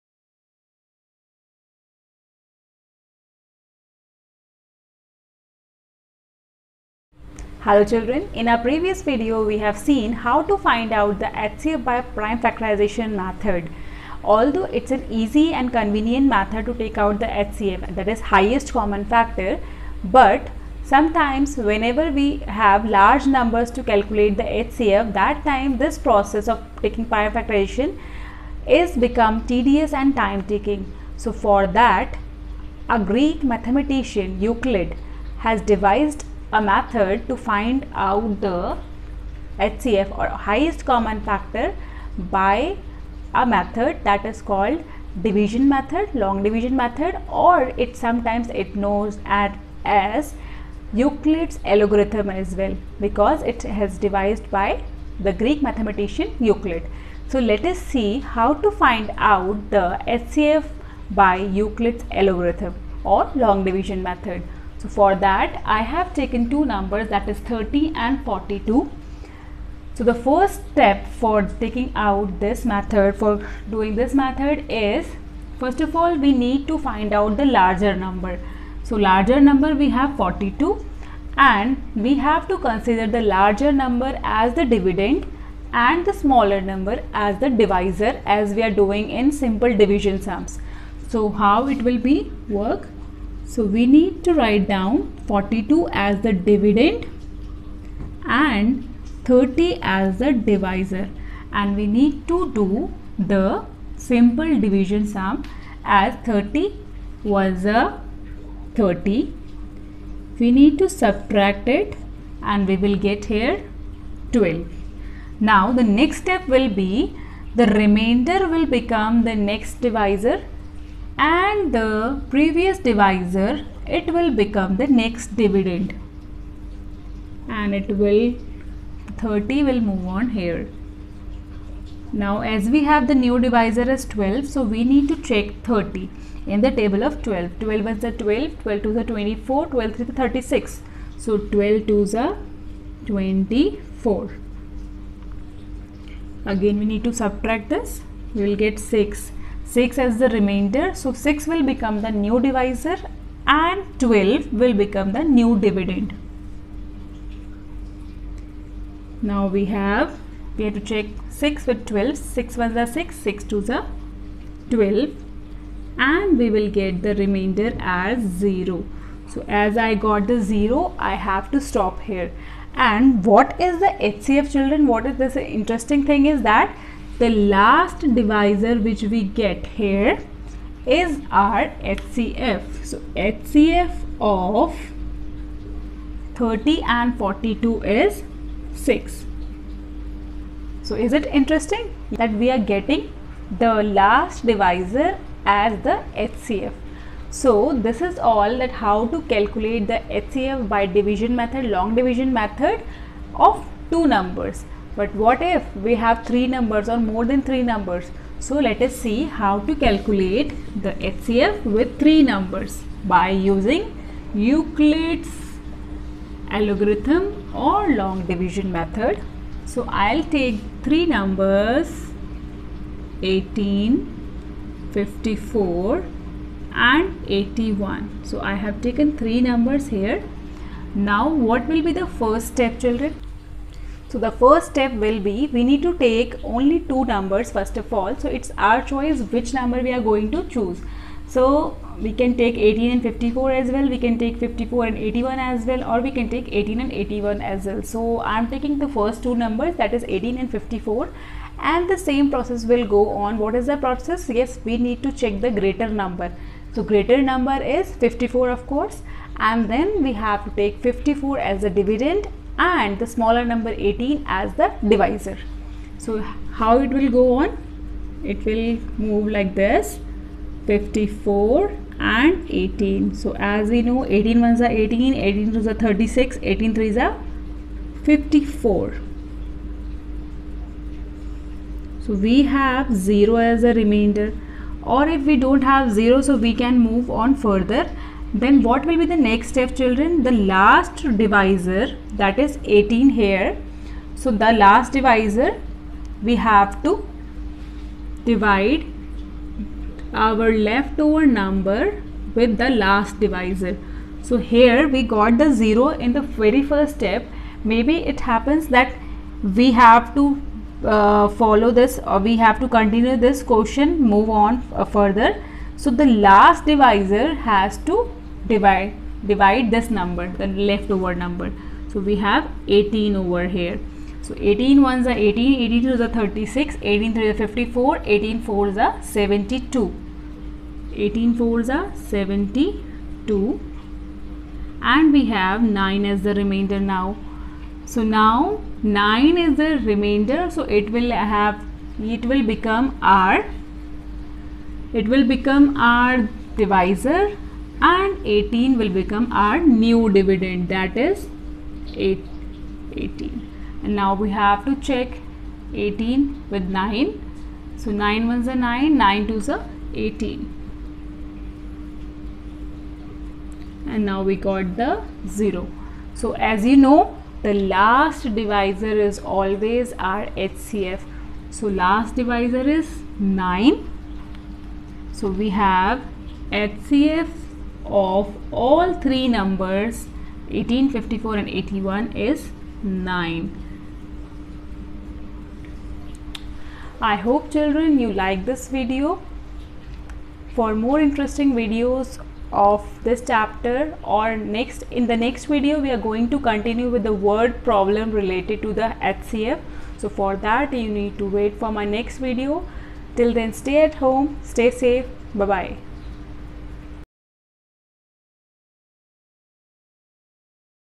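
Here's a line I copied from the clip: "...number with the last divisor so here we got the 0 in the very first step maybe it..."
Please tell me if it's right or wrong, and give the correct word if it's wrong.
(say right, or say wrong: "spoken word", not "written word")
right.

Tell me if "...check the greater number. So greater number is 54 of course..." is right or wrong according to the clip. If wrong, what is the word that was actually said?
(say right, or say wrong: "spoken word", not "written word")
right.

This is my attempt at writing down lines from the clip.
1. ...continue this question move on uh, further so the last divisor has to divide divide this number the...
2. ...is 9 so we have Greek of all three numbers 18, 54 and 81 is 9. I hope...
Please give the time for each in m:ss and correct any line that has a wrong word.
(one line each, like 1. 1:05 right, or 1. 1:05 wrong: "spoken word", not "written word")
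1. 5:12 right
2. 6:12 wrong: "HCF", not "Greek".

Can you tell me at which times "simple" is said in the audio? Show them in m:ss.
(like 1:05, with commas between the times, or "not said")
1:29, 1:43.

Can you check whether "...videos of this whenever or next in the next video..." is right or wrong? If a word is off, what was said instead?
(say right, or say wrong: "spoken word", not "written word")
wrong: "chapter", not "whenever".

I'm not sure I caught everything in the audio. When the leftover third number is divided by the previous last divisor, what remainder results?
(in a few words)
9.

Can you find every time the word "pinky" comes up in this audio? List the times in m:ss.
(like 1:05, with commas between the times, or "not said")
not said.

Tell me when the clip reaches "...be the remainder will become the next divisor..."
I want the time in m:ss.
1:56.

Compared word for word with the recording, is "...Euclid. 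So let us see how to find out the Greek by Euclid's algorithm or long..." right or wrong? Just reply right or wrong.
wrong.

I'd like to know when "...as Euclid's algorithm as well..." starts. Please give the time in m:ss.
0:49.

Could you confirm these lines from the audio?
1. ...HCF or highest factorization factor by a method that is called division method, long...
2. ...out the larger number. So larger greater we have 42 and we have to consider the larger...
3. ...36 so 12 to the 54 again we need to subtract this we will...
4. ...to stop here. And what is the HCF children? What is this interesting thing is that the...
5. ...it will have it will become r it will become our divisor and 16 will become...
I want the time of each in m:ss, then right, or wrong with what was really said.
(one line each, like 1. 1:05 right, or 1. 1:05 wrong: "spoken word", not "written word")
1. 0:39 wrong: "common", not "factorization"
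2. 1:17 wrong: "number", not "greater"
3. 2:20 wrong: "24", not "54"
4. 2:51 right
5. 5:40 wrong: "18", not "16".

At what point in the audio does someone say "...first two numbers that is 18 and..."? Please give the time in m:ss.
4:08.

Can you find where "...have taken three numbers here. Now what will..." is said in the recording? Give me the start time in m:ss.
3:48.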